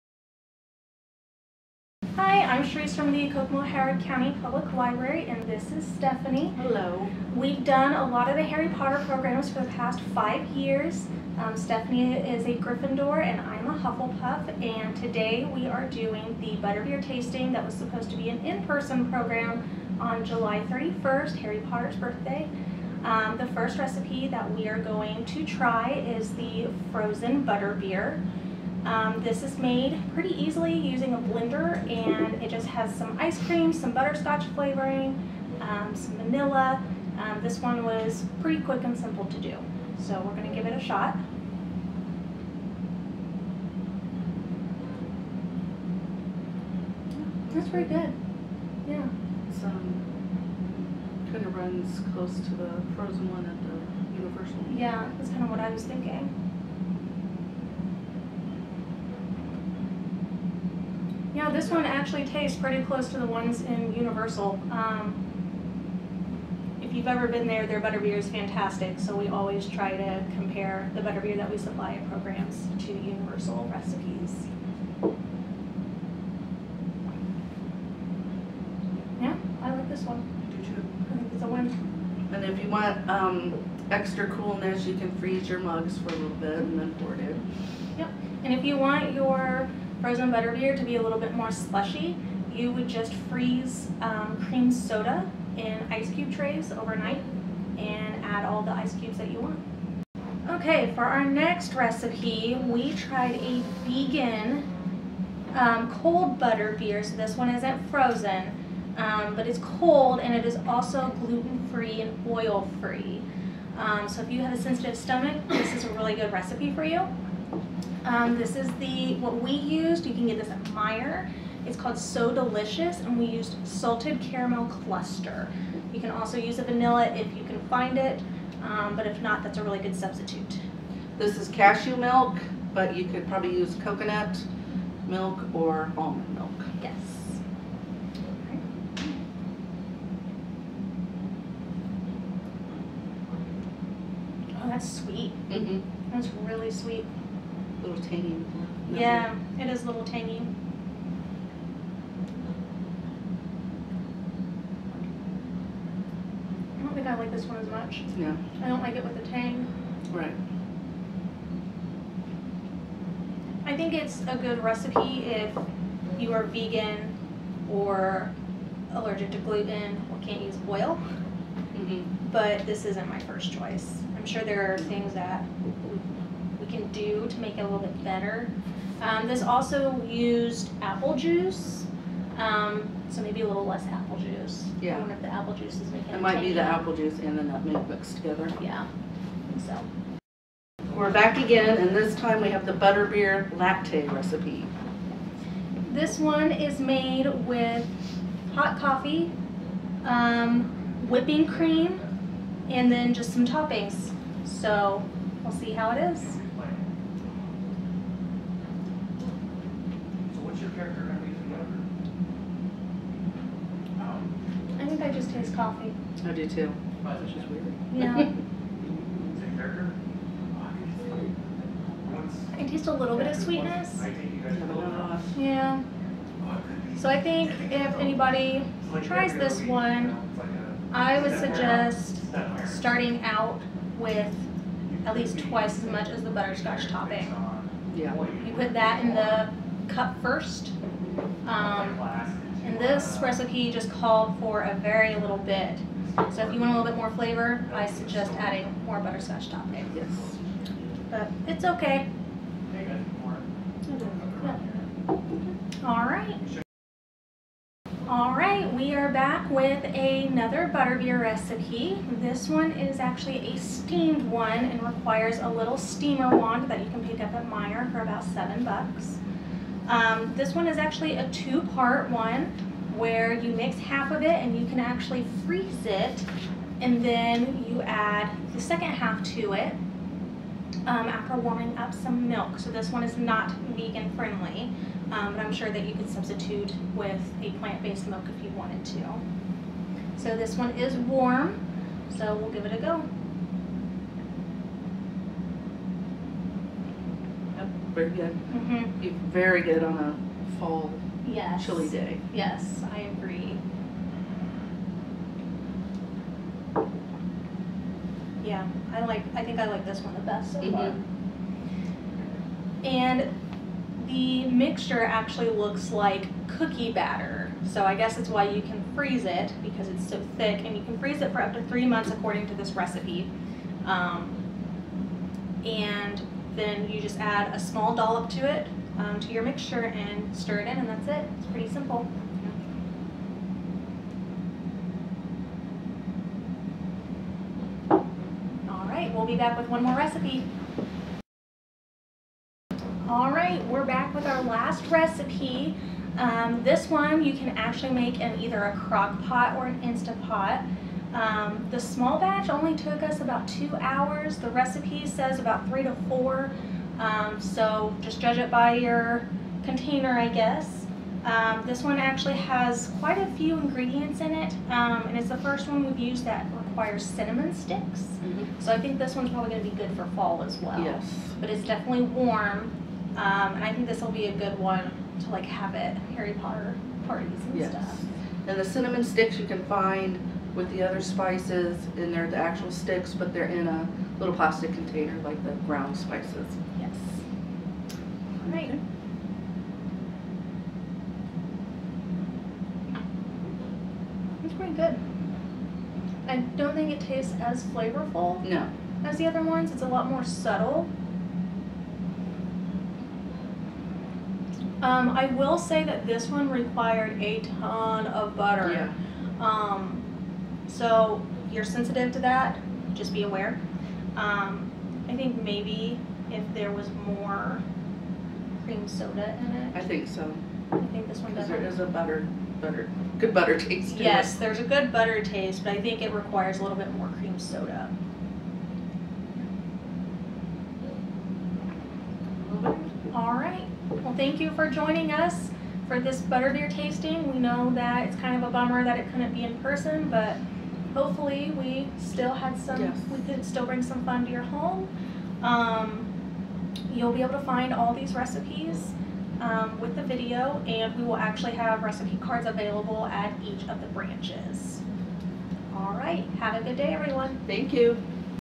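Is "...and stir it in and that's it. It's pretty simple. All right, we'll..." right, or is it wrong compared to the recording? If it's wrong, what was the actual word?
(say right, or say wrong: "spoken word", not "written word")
right.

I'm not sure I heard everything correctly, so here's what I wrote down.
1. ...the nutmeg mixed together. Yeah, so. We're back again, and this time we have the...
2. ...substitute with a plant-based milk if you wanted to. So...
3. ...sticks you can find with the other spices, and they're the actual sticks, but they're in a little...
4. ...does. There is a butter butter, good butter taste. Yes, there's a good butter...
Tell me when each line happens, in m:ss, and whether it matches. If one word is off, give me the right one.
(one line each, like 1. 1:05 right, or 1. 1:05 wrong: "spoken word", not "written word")
1. 3:07 right
2. 4:46 right
3. 6:19 right
4. 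7:01 right.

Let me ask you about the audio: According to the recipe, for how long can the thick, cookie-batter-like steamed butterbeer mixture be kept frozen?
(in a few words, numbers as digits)
3 months.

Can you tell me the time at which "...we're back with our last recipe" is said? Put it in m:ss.
5:43.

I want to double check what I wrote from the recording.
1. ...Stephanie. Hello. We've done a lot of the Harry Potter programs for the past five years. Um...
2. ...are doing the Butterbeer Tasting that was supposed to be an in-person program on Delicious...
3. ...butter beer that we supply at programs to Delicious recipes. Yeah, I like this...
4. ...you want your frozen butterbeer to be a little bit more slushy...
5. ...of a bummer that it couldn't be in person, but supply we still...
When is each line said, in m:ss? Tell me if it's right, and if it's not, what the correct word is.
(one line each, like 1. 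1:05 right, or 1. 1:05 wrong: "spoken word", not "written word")
1. 0:05 right
2. 0:15 wrong: "July", not "Delicious"
3. 1:11 wrong: "Universal", not "Delicious"
4. 1:28 right
5. 7:18 wrong: "hopefully", not "supply".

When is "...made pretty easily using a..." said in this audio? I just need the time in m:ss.
0:29.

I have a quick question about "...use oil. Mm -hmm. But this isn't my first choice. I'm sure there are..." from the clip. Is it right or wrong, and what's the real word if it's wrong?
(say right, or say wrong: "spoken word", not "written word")
right.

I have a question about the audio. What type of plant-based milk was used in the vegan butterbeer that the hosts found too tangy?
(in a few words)
cashew milk.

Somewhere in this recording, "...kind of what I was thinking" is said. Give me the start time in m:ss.
0:55.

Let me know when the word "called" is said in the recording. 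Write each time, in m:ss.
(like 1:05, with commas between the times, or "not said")
2:01, 4:03.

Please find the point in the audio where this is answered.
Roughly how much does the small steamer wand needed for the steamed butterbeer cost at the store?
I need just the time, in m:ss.
4:28.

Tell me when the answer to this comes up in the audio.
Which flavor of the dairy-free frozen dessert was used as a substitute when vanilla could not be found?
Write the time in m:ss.
2:03.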